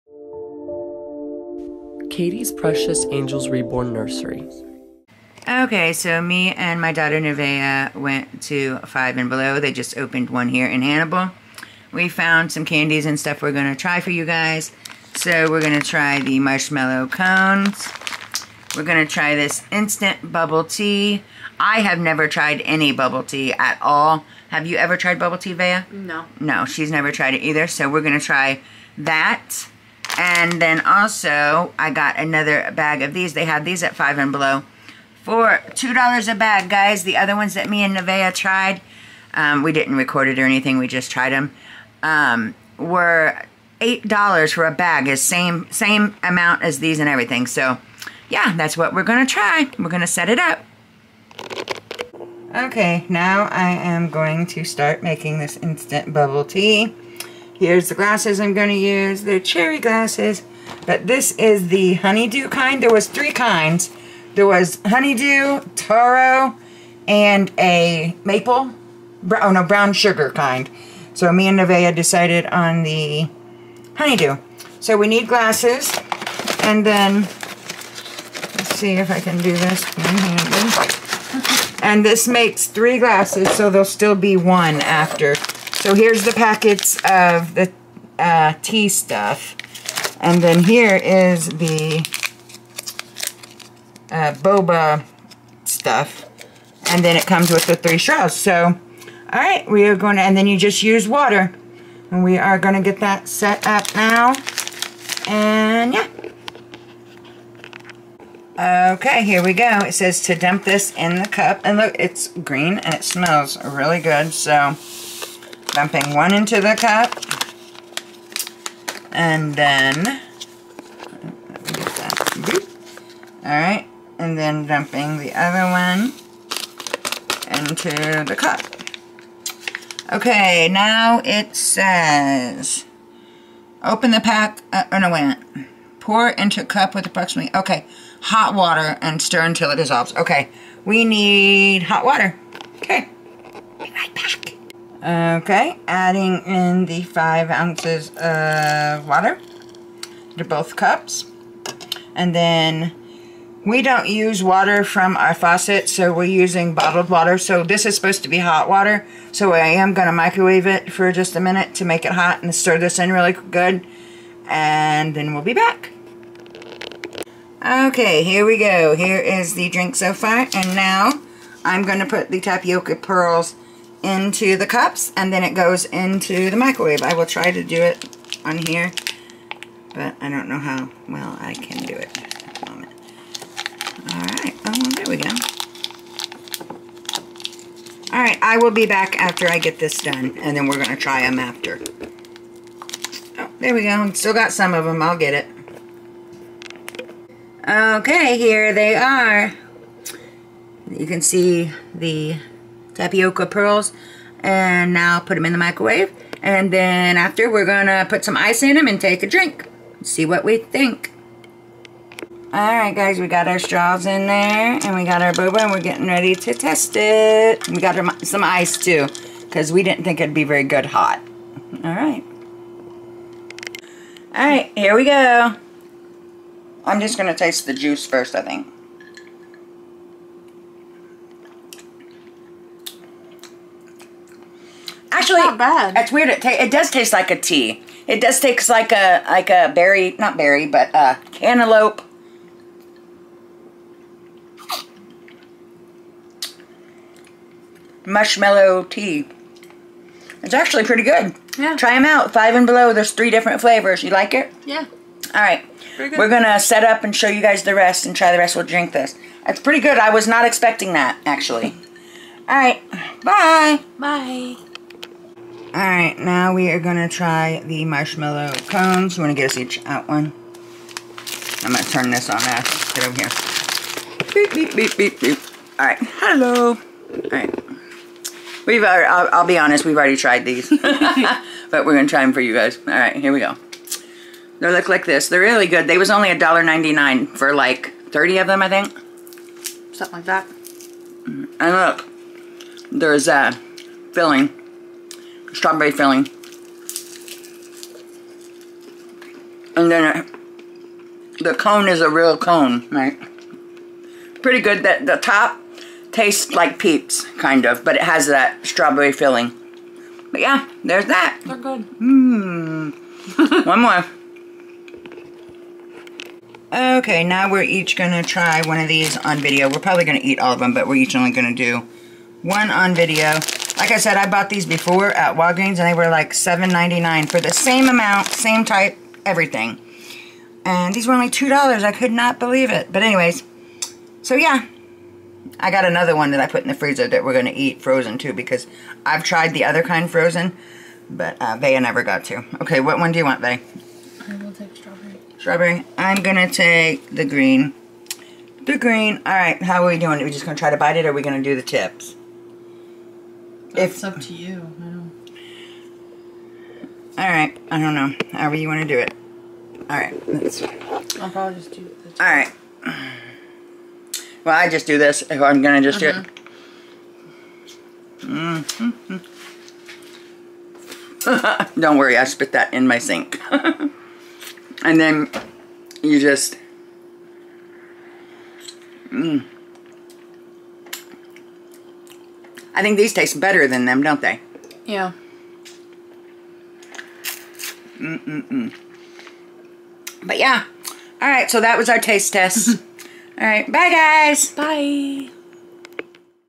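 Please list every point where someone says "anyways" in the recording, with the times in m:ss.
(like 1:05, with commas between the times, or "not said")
5:33.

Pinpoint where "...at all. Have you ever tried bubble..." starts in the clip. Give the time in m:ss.
0:23.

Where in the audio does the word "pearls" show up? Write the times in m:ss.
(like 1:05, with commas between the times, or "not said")
2:52, 3:23.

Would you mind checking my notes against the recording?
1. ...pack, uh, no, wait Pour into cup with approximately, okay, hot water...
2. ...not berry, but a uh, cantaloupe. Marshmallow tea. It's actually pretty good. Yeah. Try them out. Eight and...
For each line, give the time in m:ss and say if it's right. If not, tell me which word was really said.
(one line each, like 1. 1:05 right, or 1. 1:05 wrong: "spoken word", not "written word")
1. 2:14 right
2. 4:00 wrong: "Five", not "Eight".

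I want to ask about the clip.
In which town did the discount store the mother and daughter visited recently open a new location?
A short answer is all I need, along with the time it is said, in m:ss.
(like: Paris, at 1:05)
Hannibal, at 0:10.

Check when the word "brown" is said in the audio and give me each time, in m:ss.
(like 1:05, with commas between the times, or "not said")
1:09.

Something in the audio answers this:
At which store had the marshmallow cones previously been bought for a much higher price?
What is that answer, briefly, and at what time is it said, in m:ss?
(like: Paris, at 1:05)
Walgreens, at 5:25.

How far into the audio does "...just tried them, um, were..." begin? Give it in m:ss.
0:40.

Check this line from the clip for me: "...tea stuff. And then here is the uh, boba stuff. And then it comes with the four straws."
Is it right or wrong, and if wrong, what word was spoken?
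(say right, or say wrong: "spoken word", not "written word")
wrong: "three", not "four".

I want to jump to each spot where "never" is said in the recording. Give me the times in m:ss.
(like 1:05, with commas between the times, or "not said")
0:21, 0:26, 5:41.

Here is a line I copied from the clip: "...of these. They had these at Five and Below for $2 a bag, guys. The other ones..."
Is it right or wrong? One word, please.
right.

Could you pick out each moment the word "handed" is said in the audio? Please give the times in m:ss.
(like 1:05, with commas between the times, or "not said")
1:19.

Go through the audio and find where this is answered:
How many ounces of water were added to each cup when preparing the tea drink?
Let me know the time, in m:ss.
2:27.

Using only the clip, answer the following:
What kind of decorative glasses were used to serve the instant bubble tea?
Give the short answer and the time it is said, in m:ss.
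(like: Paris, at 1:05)
Cherry glasses, at 0:59.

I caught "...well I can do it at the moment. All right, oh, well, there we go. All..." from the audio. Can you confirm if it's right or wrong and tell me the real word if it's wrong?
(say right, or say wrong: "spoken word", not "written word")
right.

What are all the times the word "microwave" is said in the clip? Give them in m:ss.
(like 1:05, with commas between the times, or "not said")
2:40, 2:56, 3:25.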